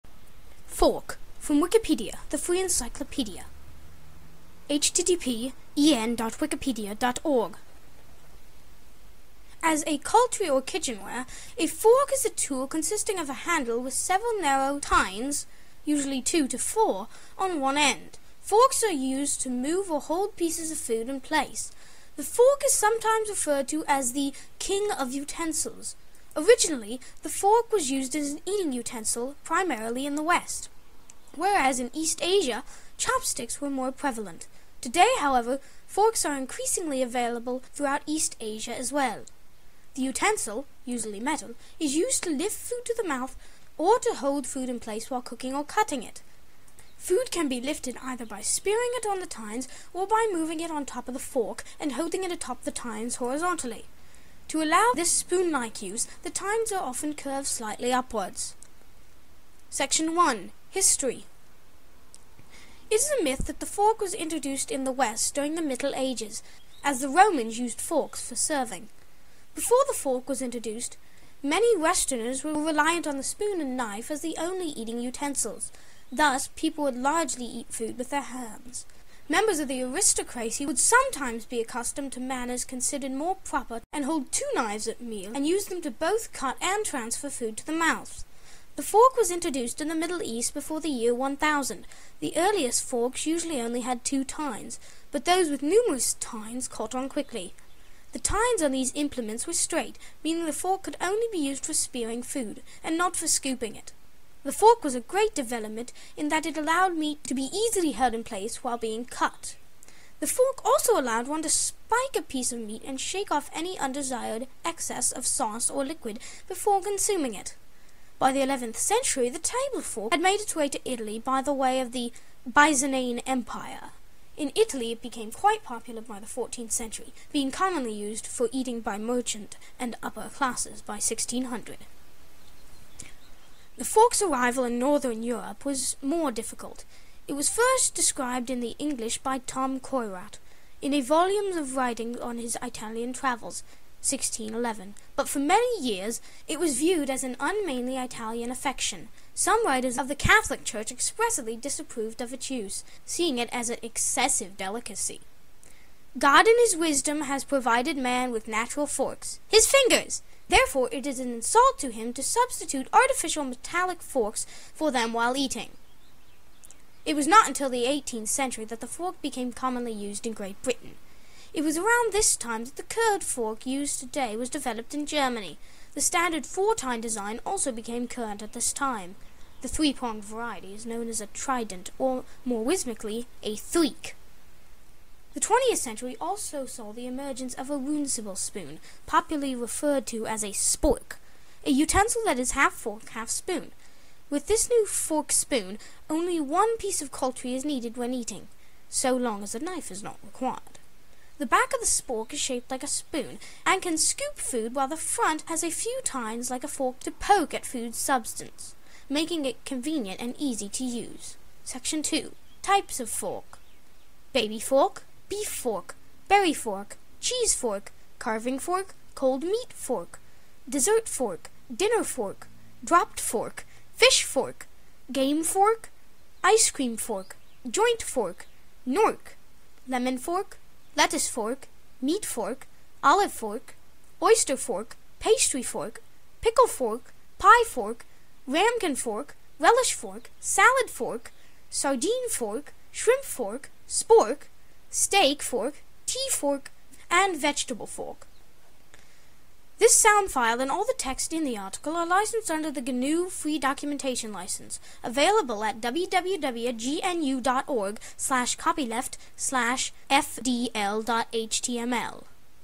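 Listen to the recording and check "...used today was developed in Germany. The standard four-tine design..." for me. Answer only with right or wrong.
right.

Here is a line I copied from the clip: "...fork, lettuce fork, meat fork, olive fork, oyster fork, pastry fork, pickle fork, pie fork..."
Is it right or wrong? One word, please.
right.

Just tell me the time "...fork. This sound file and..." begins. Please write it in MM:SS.
04:07.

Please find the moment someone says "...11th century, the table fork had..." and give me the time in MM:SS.
01:58.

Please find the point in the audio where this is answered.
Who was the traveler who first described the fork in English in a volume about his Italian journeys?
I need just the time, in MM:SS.
02:19.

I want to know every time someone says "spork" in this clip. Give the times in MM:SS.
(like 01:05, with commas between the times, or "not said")
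03:10, 03:21, 04:03.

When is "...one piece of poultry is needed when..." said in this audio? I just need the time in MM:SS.
03:16.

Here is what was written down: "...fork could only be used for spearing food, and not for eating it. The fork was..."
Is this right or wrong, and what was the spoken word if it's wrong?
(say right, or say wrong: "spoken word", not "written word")
wrong: "scooping", not "eating".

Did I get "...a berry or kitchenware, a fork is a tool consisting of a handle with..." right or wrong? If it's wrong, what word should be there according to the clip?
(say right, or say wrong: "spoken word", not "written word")
wrong: "cutlery", not "berry".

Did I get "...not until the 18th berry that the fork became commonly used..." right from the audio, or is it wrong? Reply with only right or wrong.
wrong.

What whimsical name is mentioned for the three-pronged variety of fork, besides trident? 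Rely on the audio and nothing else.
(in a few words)
threek.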